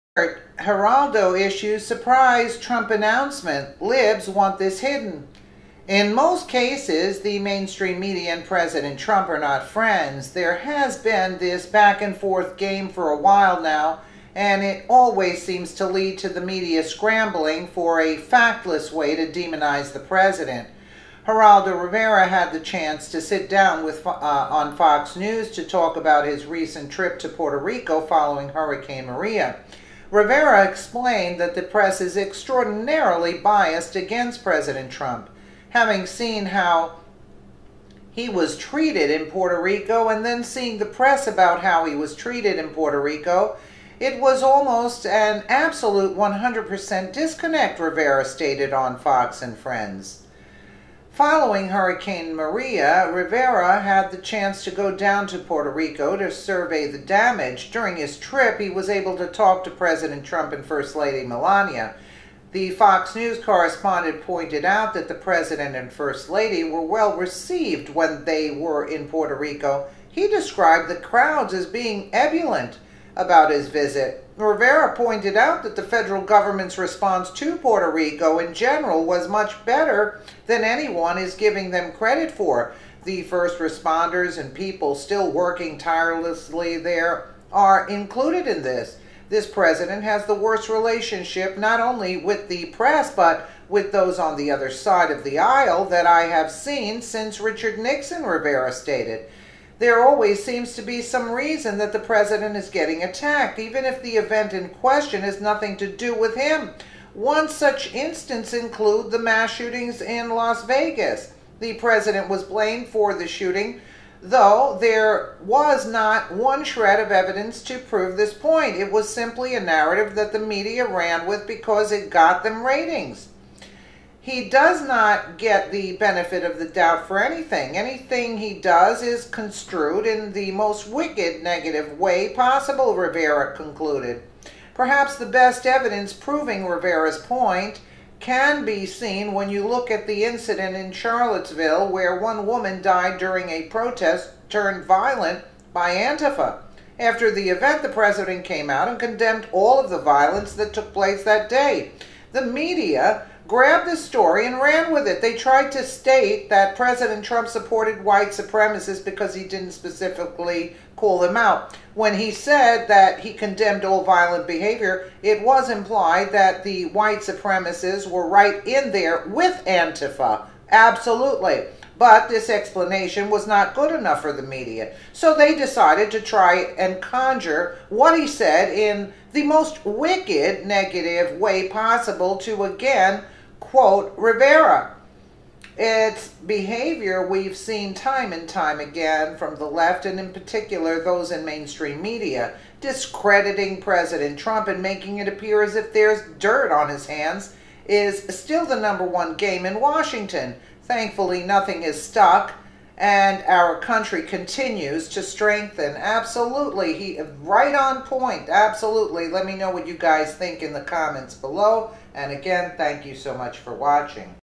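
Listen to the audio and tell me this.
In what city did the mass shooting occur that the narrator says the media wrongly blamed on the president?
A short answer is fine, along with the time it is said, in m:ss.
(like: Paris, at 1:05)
Las Vegas, at 1:50.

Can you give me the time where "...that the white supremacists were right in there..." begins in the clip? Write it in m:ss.
2:46.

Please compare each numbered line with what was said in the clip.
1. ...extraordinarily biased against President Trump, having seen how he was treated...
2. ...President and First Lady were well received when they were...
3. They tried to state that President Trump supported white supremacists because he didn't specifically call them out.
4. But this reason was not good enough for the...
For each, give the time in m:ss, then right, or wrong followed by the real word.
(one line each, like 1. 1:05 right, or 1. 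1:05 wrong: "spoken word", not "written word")
1. 0:32 right
2. 1:05 right
3. 2:35 right
4. 2:51 wrong: "explanation", not "reason".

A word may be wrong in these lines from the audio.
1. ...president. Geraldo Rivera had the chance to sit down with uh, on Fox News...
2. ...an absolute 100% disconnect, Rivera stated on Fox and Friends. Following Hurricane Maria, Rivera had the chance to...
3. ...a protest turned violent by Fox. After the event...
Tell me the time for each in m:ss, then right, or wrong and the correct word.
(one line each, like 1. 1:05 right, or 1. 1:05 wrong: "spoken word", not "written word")
1. 0:20 right
2. 0:45 right
3. 2:23 wrong: "Antifa", not "Fox".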